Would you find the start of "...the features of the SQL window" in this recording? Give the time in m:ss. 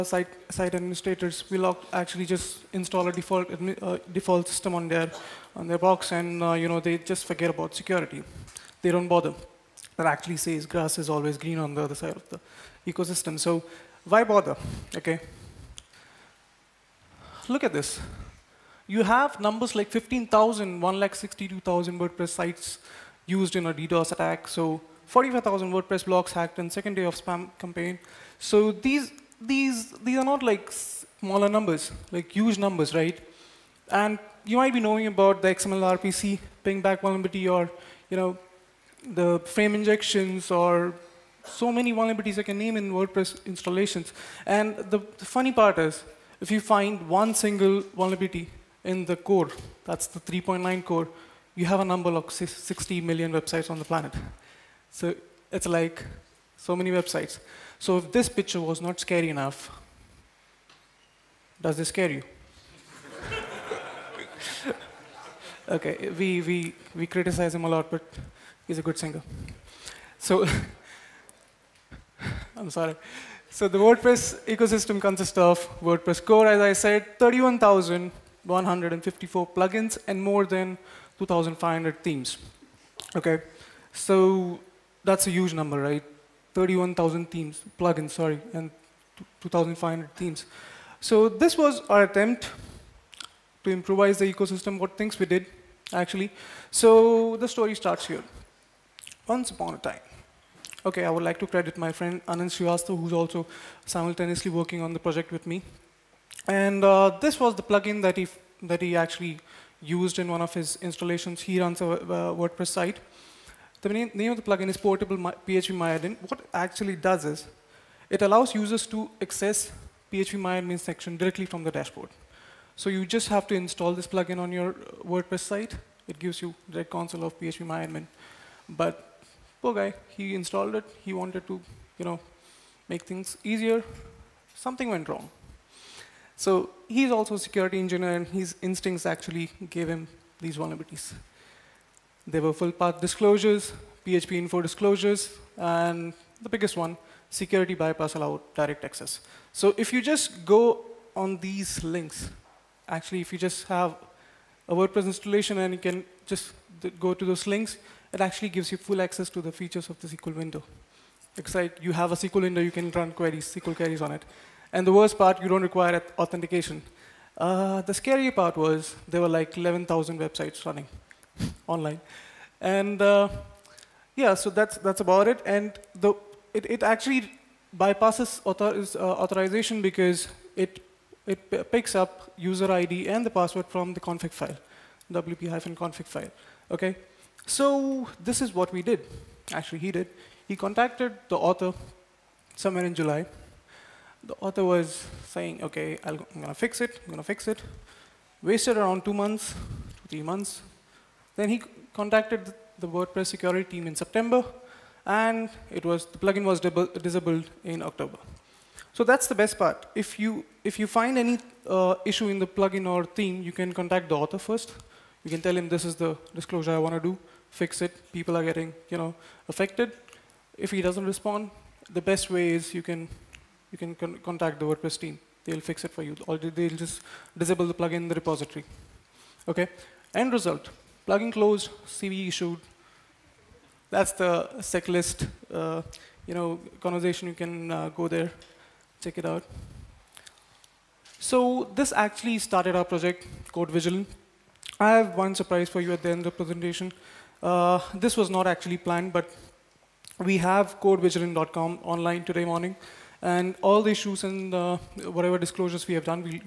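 2:39.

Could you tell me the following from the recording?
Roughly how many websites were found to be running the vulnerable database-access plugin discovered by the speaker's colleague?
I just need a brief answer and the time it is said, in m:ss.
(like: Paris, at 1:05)
11,000, at 2:49.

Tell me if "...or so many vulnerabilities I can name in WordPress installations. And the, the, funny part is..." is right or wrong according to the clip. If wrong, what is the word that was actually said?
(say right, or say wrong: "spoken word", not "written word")
right.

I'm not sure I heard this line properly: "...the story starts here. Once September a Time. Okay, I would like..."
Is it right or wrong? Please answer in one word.
wrong.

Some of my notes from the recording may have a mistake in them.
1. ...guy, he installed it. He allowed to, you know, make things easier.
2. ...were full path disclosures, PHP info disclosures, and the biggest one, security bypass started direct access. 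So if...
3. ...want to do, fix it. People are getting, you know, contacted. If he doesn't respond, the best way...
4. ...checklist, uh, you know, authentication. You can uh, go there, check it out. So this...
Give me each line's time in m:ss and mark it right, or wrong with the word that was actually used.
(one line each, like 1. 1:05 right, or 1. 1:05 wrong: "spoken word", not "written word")
1. 2:09 wrong: "wanted", not "allowed"
2. 2:22 wrong: "allowed", not "started"
3. 3:36 wrong: "affected", not "contacted"
4. 3:54 wrong: "conversation", not "authentication".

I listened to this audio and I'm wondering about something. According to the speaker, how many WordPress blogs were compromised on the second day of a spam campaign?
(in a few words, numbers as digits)
45,000.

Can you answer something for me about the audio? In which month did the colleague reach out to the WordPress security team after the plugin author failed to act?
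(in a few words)
September.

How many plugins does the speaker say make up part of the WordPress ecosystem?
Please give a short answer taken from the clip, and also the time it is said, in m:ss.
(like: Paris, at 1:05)
31,154, at 1:17.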